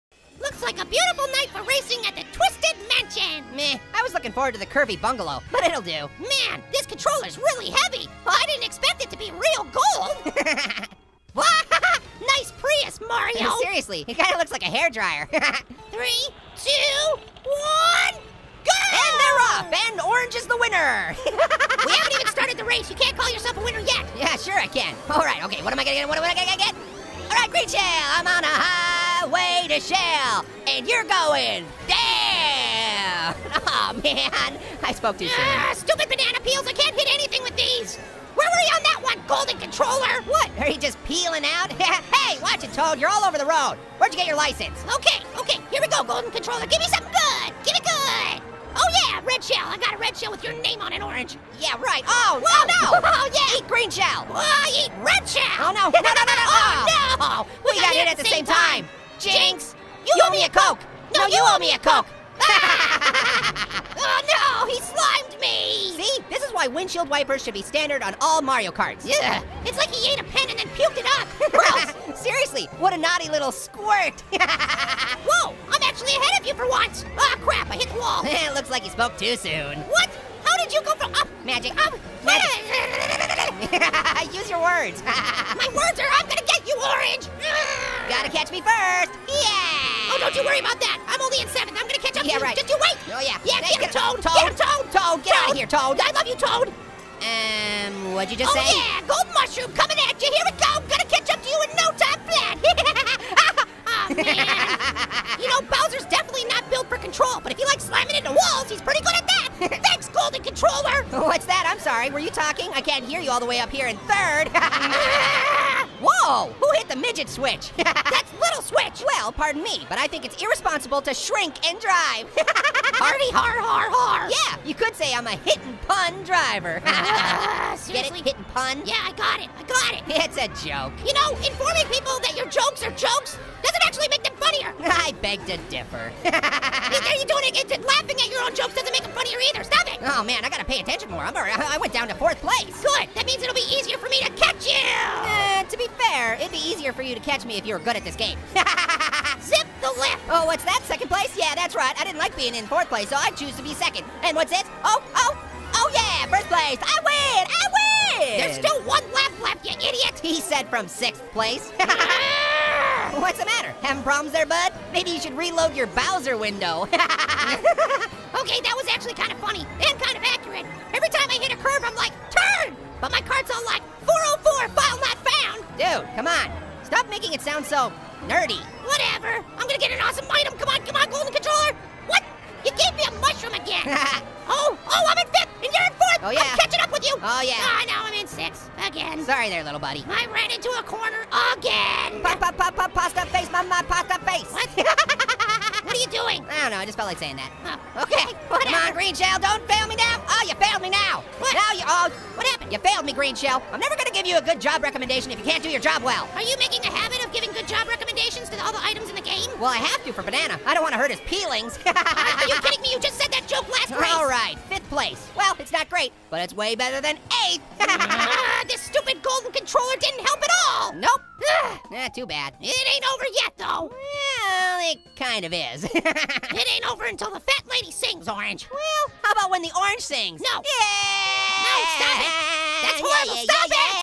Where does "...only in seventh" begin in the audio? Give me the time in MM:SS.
01:31.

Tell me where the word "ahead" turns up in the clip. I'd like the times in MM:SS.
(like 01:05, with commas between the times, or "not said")
01:16.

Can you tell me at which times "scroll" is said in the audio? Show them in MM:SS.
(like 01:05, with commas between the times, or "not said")
not said.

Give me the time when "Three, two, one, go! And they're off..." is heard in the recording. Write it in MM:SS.
00:15.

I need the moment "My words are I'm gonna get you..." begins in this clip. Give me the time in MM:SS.
01:25.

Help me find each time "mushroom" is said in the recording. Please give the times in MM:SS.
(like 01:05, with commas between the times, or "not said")
01:39, 03:03.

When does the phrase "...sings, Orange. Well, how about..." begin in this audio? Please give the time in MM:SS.
03:47.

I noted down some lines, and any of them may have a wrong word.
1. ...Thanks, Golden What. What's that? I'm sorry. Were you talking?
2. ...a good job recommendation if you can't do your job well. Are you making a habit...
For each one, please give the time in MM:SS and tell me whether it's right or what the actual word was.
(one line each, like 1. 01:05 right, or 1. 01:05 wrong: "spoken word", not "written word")
1. 01:49 wrong: "Controller", not "What"
2. 03:24 right.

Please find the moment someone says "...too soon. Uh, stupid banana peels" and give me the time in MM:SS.
00:35.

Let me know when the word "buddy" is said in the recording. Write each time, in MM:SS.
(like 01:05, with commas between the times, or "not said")
03:09.